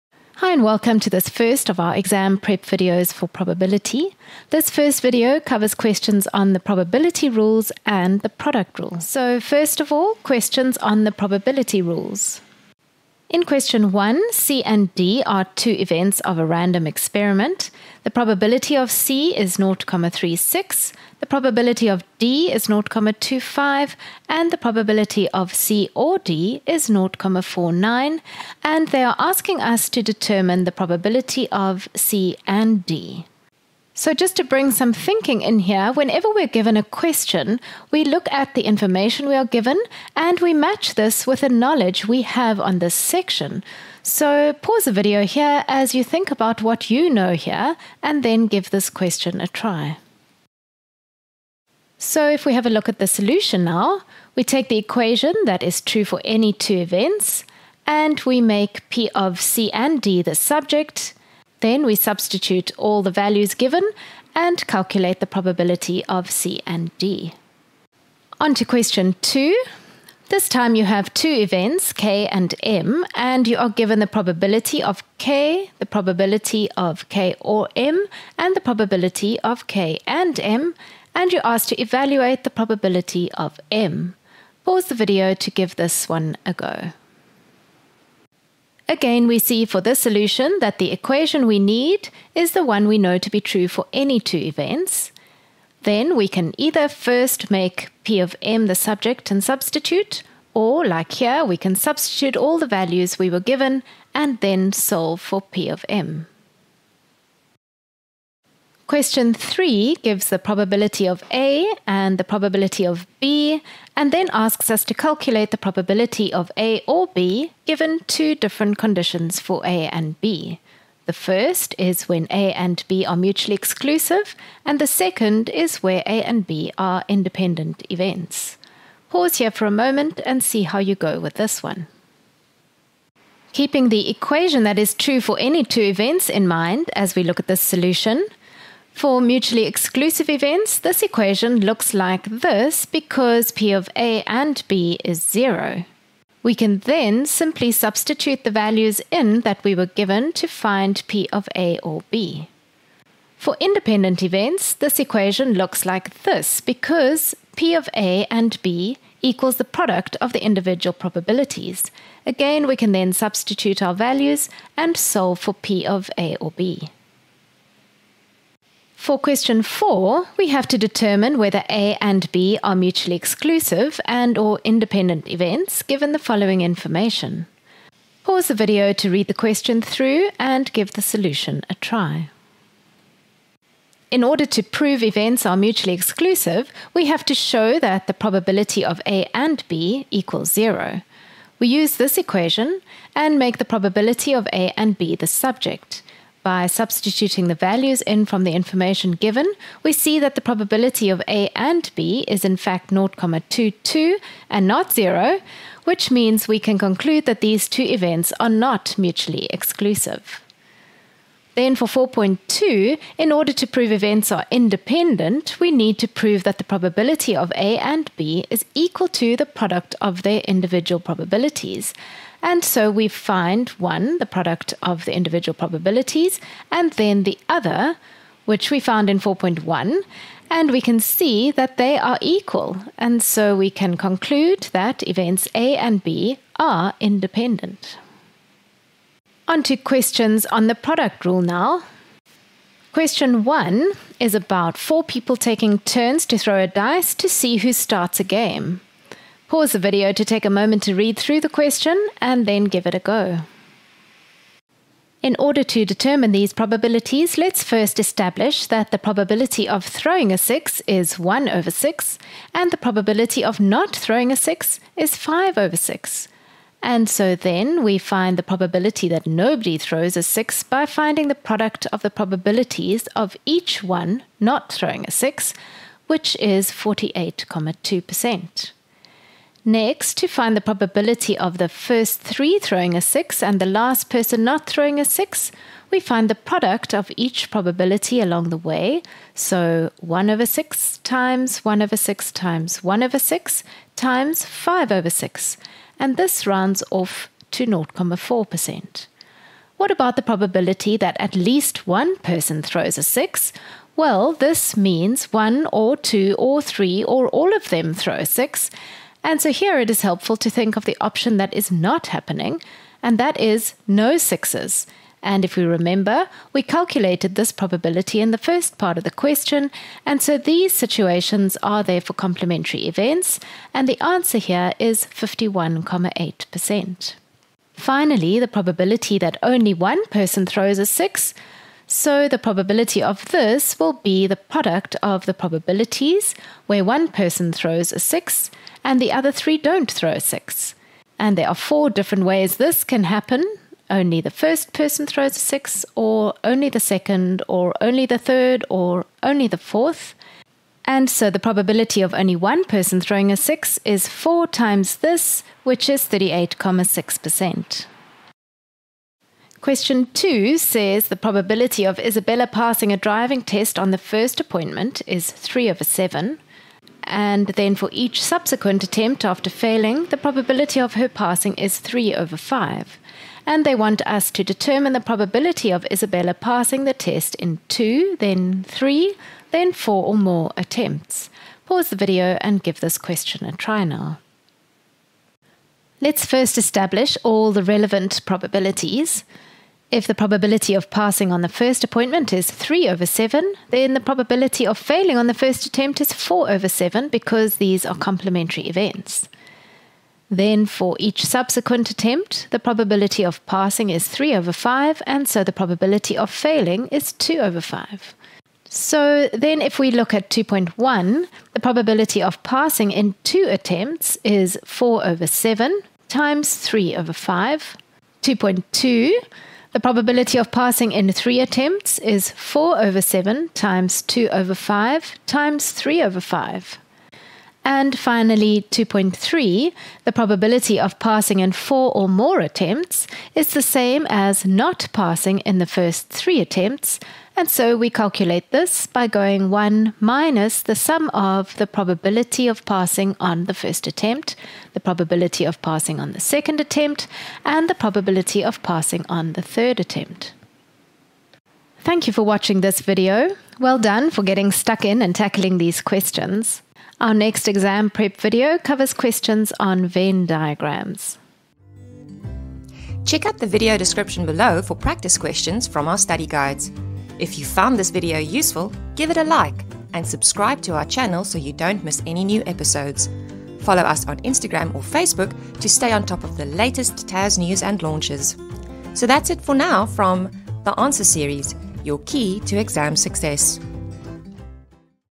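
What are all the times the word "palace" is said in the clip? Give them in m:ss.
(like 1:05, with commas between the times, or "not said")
not said.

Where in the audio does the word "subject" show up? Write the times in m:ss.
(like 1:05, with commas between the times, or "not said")
1:00, 1:38, 3:15.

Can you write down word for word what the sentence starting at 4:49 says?
So 1 over 6 times 1 over 6 times 1 over 6 times 5 over 6.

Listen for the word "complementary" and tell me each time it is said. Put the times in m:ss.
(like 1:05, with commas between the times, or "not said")
5:22, 6:37.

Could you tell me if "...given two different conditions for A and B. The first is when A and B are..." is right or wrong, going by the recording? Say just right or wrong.
right.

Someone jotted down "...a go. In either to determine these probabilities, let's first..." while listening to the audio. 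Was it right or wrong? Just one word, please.
wrong.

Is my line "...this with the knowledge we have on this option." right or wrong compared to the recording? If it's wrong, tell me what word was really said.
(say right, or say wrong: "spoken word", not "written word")
wrong: "section", not "option".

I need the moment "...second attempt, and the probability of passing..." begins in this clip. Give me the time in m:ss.
7:26.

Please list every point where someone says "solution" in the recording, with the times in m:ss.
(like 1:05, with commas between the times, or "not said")
0:53, 1:29, 2:17, 3:01.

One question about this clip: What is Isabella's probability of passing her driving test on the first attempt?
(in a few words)
3/7.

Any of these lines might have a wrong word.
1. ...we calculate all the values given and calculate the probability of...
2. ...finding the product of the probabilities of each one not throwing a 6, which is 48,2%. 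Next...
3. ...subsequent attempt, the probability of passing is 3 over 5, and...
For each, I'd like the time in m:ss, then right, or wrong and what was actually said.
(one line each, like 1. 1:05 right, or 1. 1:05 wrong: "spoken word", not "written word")
1. 1:01 wrong: "substitute", not "calculate"
2. 4:30 right
3. 6:41 right.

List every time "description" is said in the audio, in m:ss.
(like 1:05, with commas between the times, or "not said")
7:43.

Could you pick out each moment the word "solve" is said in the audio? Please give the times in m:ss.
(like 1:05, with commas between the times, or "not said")
1:44, 2:44.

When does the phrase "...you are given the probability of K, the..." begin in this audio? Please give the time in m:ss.
1:13.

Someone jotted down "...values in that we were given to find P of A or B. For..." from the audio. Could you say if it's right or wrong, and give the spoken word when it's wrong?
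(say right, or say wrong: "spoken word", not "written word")
right.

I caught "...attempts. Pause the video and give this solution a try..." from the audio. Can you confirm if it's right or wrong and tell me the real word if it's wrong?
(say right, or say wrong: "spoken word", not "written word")
wrong: "question", not "solution".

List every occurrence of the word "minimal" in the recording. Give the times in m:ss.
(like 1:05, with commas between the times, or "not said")
not said.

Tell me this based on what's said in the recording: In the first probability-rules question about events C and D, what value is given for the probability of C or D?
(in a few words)
0,49.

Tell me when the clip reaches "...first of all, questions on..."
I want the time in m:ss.
0:09.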